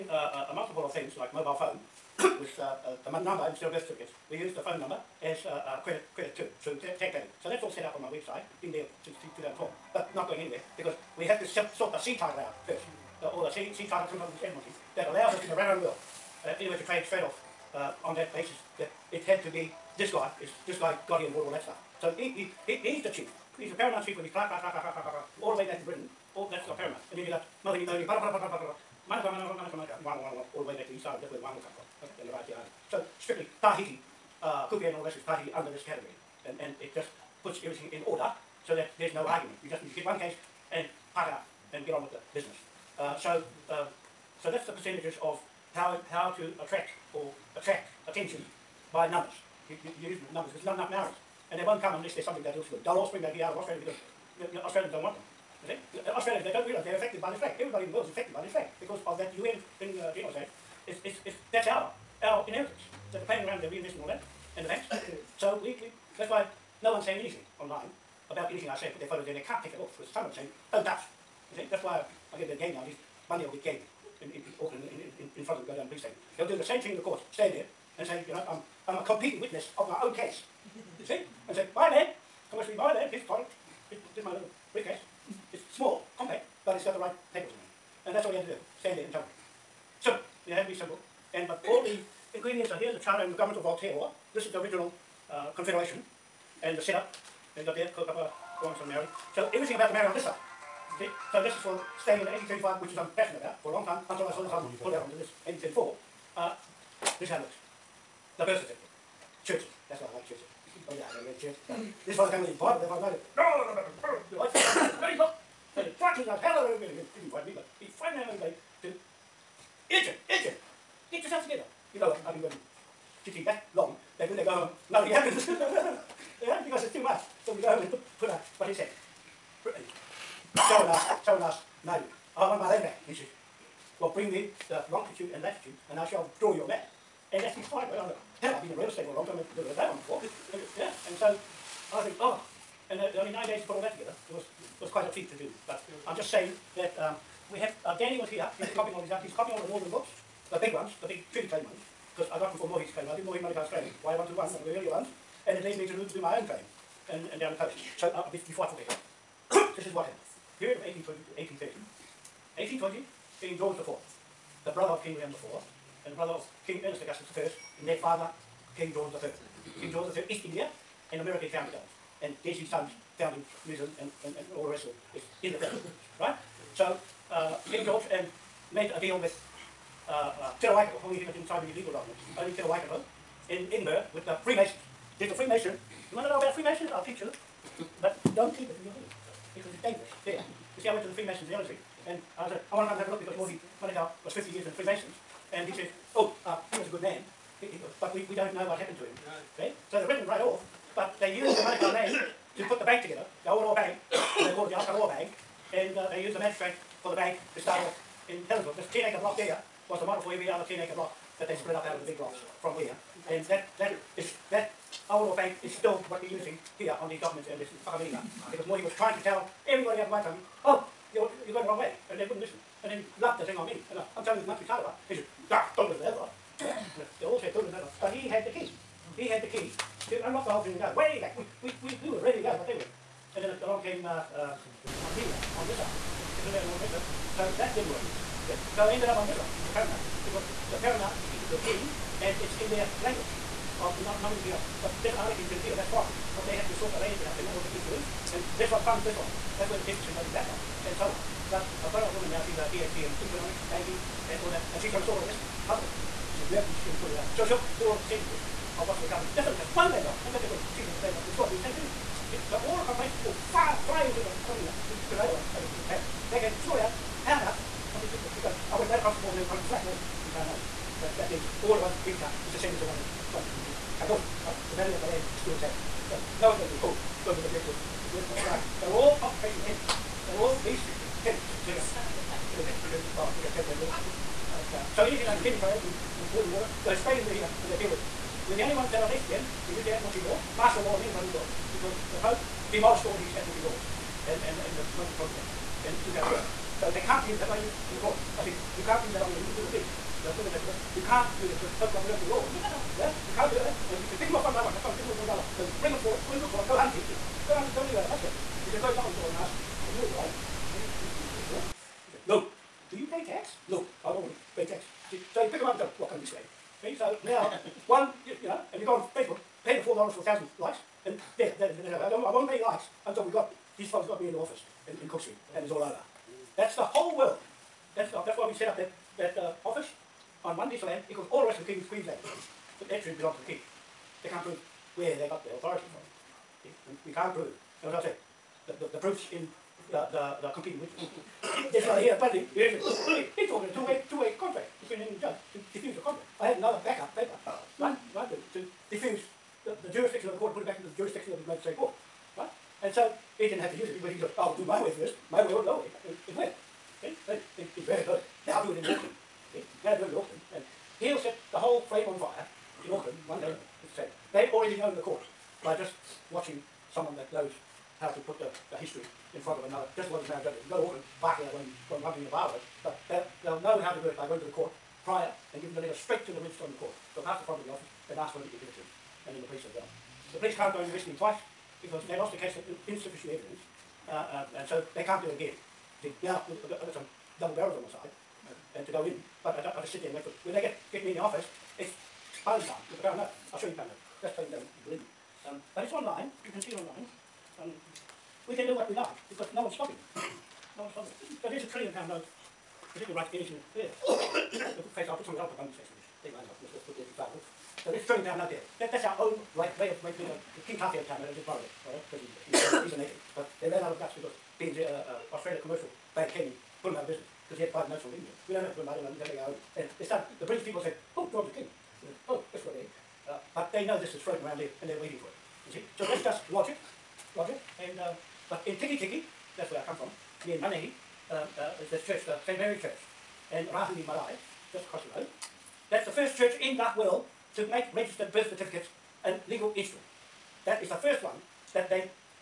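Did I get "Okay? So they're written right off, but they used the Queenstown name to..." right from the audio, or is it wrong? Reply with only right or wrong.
wrong.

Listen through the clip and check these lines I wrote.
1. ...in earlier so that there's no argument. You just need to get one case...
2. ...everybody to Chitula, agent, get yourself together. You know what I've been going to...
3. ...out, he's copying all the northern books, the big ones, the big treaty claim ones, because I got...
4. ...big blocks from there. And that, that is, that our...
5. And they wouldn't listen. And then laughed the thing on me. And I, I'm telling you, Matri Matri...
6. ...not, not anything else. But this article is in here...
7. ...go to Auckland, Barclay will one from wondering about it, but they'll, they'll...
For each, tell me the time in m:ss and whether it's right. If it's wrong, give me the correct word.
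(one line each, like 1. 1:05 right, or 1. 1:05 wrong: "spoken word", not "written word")
1. 0:37 wrong: "order", not "earlier"
2. 1:58 wrong: "Agent", not "Chitula"
3. 2:29 right
4. 3:32 right
5. 3:42 wrong: "Tarawa", not "Matri"
6. 4:04 right
7. 6:10 right.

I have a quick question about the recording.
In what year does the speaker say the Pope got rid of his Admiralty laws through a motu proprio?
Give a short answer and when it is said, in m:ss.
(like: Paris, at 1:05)
2012, at 4:56.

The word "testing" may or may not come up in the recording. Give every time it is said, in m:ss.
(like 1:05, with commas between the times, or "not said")
not said.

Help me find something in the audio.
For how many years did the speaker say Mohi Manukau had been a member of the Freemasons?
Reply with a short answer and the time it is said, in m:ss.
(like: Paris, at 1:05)
50, at 3:14.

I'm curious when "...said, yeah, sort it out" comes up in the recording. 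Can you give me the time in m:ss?
4:16.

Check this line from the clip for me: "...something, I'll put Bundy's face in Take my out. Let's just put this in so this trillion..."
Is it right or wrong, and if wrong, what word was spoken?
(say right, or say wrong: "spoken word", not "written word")
right.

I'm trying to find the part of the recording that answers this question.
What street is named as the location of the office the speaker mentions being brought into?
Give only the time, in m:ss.
5:25.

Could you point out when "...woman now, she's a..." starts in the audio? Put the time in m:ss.
4:12.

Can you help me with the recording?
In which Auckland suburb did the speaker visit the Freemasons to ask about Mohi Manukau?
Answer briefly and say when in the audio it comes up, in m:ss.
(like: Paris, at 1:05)
Ellerslie, at 3:11.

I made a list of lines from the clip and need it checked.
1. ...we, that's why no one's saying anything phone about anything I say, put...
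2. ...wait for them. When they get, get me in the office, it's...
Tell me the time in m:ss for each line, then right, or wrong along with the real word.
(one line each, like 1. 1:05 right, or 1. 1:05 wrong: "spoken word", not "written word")
1. 1:05 wrong: "online", not "phone"
2. 6:30 right.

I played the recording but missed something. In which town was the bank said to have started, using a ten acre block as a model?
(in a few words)
Helensville.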